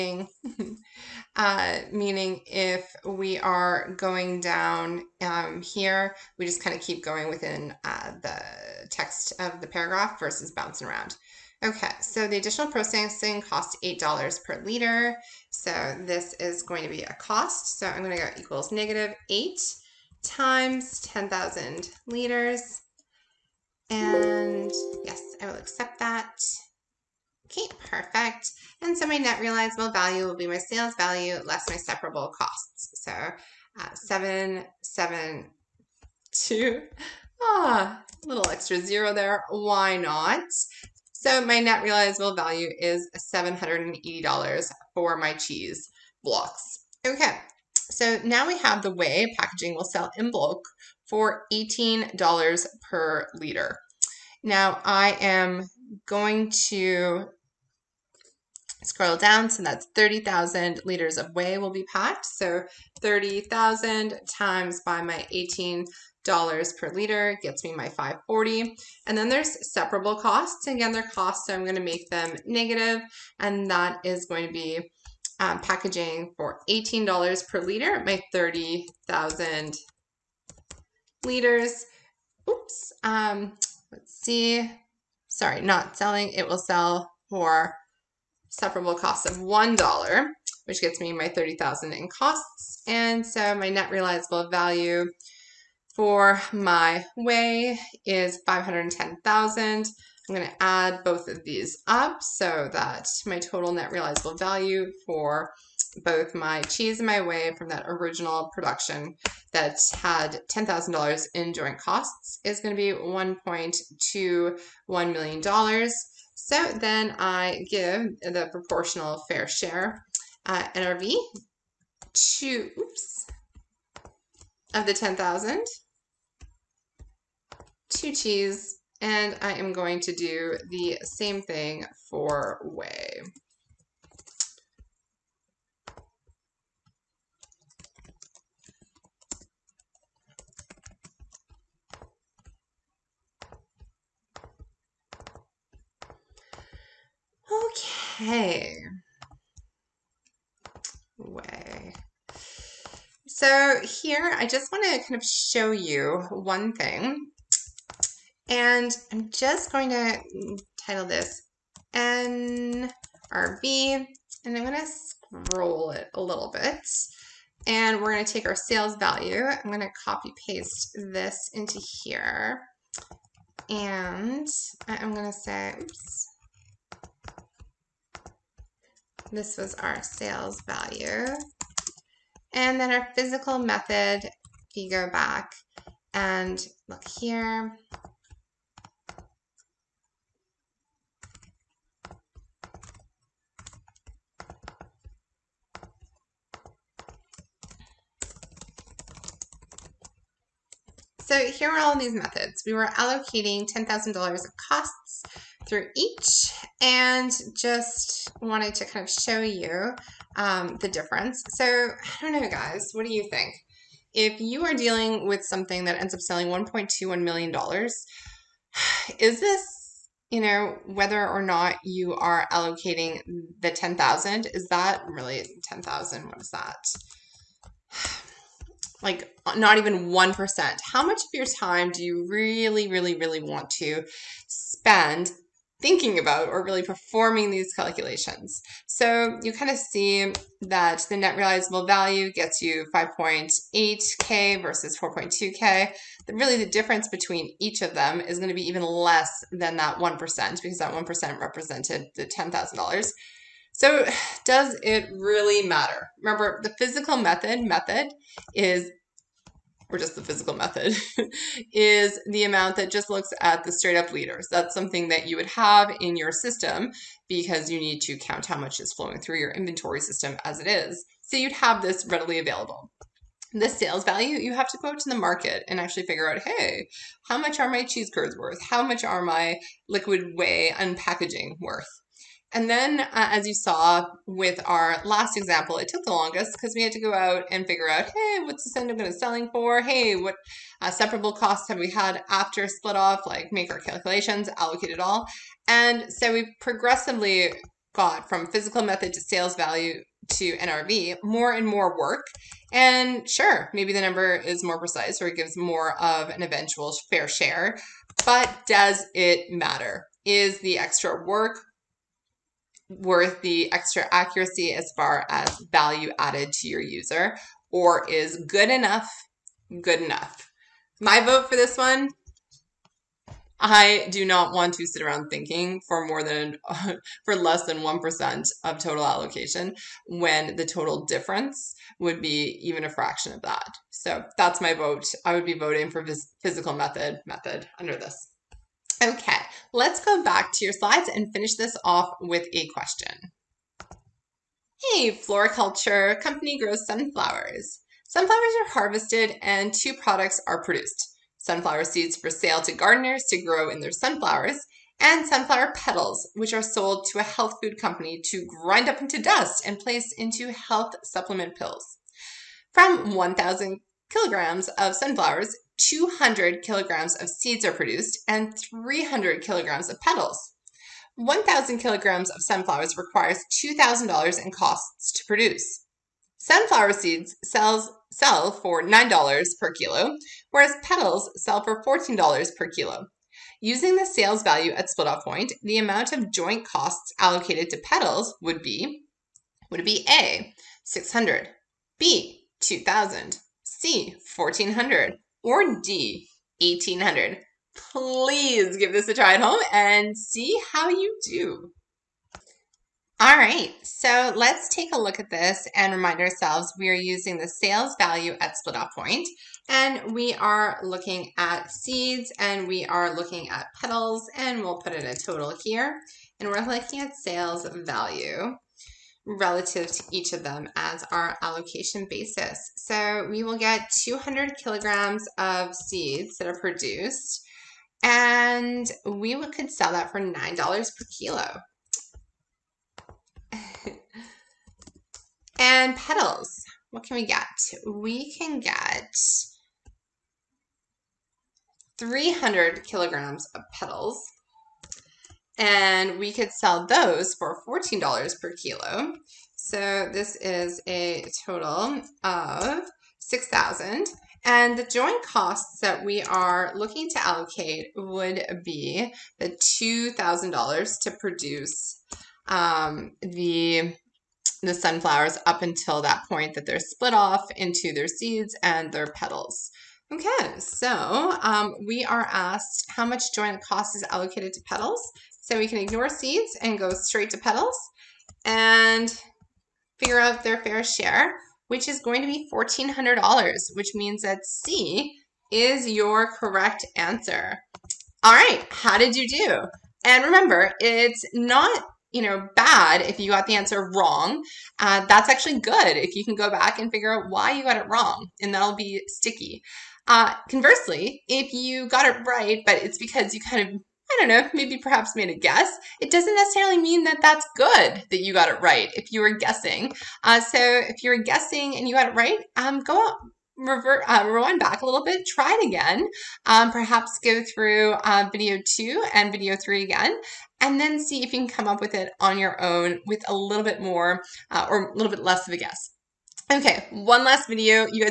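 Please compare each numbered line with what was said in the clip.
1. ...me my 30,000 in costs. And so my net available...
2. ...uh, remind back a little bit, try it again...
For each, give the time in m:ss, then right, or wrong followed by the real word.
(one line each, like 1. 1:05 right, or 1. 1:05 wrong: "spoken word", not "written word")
1. 1:30 wrong: "realizable", not "available"
2. 8:34 wrong: "rewind", not "remind".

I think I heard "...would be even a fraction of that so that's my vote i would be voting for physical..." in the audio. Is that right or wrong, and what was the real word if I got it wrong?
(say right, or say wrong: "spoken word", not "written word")
right.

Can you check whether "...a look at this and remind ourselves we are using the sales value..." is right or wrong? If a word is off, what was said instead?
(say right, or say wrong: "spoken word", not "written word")
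right.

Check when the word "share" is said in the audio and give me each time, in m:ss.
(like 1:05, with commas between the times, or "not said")
1:59, 5:07, 8:00.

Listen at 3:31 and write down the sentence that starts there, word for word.
So I don't know, guys, what do you think?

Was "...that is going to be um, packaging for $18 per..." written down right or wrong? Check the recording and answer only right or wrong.
right.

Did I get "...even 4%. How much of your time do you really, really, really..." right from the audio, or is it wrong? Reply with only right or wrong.
wrong.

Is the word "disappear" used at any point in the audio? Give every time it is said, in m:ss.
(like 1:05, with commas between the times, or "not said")
not said.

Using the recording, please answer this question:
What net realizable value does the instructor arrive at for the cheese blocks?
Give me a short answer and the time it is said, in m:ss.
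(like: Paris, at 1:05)
$780, at 0:43.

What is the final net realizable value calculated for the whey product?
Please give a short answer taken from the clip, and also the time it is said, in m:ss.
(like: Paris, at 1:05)
510,000, at 1:38.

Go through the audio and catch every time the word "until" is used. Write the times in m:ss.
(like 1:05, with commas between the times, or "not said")
7:45.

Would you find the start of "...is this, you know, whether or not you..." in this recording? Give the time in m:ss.
3:39.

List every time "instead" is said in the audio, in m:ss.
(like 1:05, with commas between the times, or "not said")
not said.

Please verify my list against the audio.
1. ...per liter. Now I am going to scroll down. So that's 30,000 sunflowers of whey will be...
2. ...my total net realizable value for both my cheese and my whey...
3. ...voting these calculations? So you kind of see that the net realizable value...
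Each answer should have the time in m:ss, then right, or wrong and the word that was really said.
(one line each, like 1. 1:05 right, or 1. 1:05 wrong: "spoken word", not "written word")
1. 0:52 wrong: "liters", not "sunflowers"
2. 1:43 right
3. 3:56 wrong: "performing", not "voting".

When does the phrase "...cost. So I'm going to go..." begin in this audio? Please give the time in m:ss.
0:17.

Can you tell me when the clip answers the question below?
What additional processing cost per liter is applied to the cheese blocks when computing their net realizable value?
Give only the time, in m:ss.
0:13.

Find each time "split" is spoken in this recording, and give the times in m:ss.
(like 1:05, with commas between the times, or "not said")
4:52, 6:24, 6:48, 7:46.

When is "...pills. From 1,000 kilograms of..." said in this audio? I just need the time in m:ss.
6:01.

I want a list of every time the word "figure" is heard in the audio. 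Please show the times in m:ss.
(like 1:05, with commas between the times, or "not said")
4:36, 4:47, 7:59, 8:16.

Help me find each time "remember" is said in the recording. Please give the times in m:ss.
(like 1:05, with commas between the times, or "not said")
4:16, 8:10.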